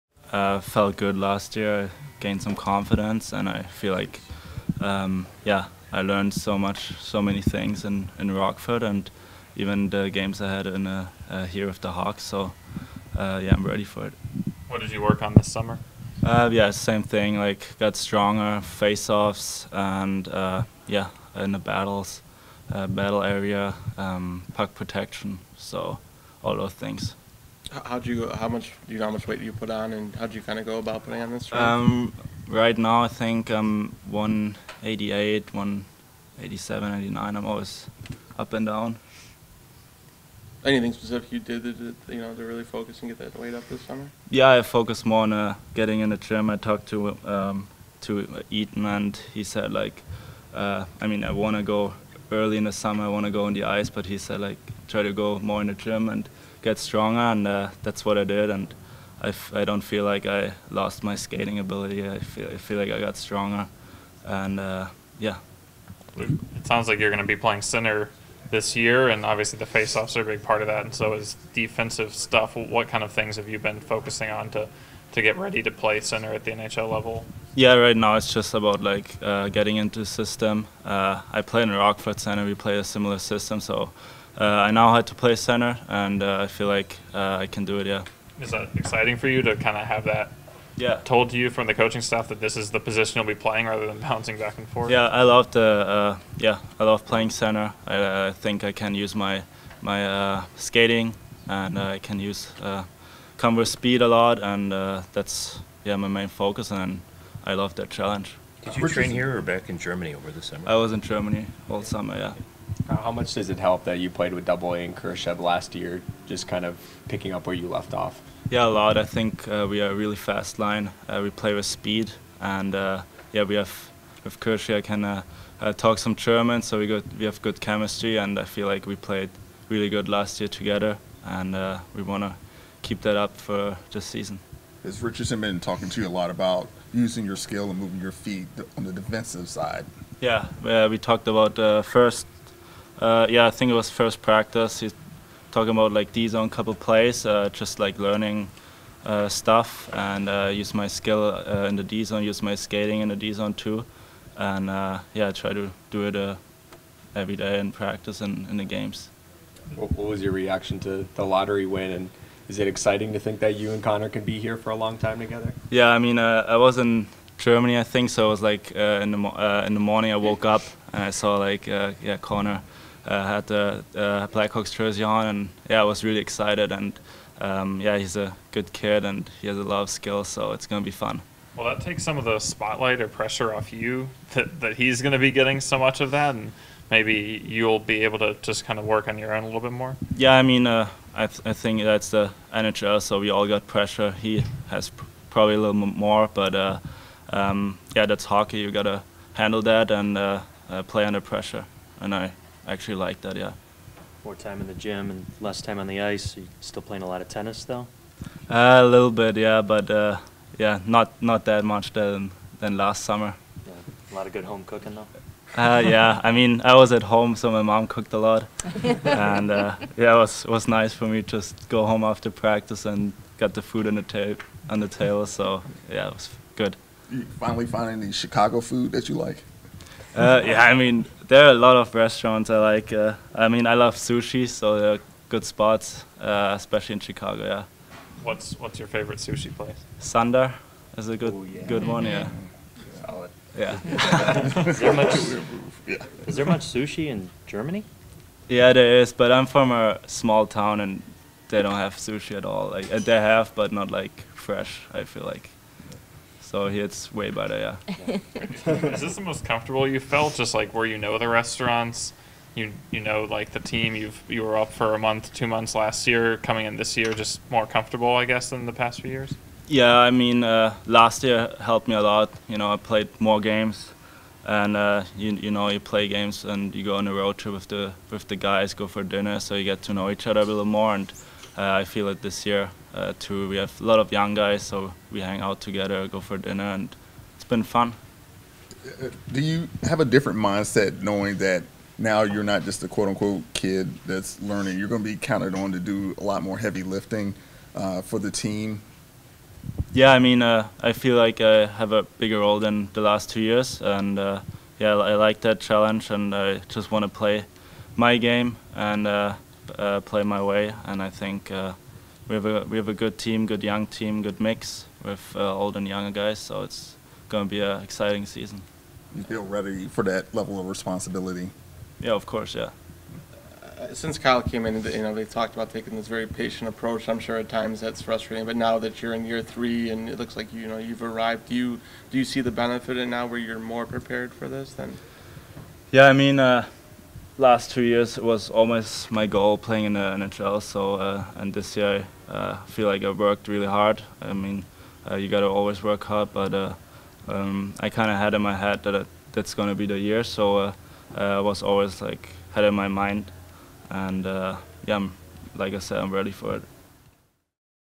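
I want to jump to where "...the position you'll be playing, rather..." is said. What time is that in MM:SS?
01:32.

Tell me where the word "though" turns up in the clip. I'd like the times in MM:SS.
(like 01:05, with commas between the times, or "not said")
03:27, 03:34.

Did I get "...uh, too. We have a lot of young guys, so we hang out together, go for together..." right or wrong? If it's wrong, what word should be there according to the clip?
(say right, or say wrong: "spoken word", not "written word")
wrong: "dinner", not "together".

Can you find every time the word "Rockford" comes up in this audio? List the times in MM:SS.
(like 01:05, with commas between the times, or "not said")
00:08, 01:21.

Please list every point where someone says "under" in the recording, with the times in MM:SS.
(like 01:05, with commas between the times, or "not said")
03:21.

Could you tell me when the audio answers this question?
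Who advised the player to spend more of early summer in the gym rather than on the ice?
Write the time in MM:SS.
00:48.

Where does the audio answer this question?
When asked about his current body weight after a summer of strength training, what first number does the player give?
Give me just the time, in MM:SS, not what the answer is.
00:34.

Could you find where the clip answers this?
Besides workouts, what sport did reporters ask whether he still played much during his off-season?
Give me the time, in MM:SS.
03:27.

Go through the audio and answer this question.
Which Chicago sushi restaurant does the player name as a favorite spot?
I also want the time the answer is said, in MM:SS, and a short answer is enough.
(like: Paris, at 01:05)
Sandar, at 03:59.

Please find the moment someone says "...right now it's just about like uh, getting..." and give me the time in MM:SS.
01:17.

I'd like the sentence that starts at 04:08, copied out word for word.
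Yeah, there is, but I'm from a small town and they don't have sushi at all.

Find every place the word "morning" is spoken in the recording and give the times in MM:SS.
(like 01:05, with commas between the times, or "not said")
02:49.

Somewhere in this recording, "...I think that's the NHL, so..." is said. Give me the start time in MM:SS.
03:11.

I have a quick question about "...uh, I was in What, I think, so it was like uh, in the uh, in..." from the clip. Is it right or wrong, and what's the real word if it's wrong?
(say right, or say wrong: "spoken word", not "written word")
wrong: "Germany", not "What".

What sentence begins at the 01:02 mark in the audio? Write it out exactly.
I feel I feel like I got stronger, and uh, yeah.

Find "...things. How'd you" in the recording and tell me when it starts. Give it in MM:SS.
00:26.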